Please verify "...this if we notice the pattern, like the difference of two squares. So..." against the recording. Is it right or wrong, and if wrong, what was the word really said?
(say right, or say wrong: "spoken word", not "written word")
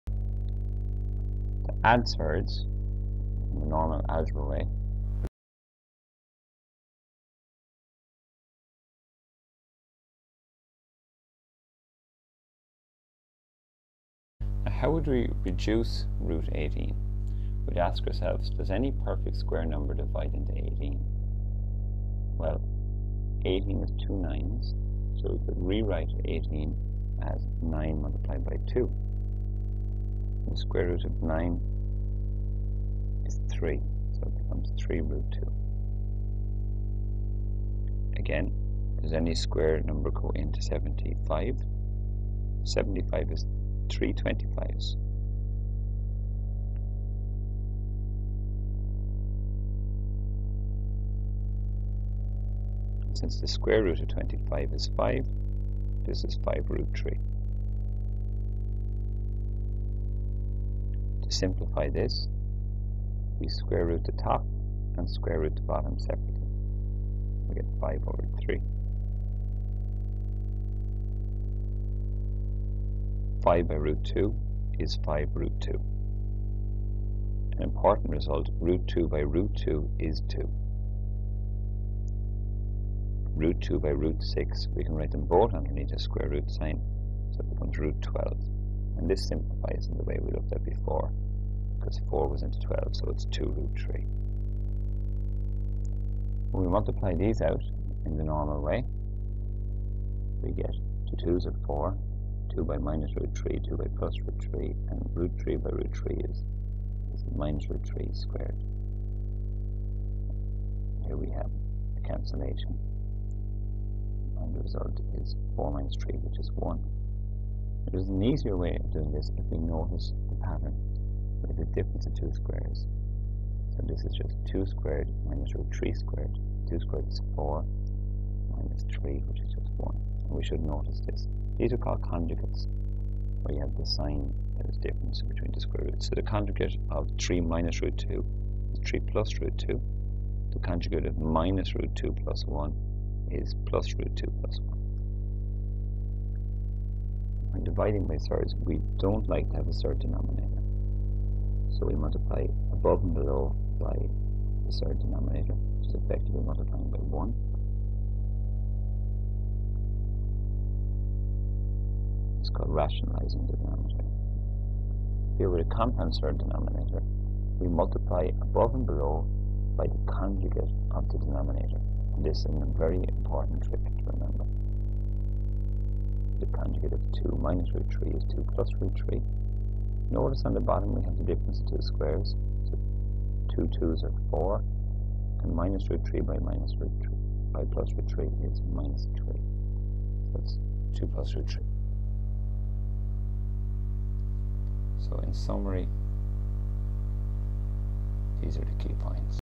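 right.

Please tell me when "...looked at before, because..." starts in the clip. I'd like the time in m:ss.
1:30.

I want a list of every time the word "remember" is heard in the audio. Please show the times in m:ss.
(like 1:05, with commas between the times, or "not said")
2:54.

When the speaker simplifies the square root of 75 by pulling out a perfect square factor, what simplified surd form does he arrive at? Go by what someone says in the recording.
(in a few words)
5 root 3.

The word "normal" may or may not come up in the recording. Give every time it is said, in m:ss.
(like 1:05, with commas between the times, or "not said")
0:03, 1:38.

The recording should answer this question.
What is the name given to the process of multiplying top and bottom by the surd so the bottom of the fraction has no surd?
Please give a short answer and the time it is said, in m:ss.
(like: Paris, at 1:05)
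Rationalizing the denominator, at 2:42.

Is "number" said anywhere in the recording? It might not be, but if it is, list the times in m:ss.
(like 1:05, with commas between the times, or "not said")
0:19, 0:39.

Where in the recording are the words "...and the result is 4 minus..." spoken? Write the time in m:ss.
1:54.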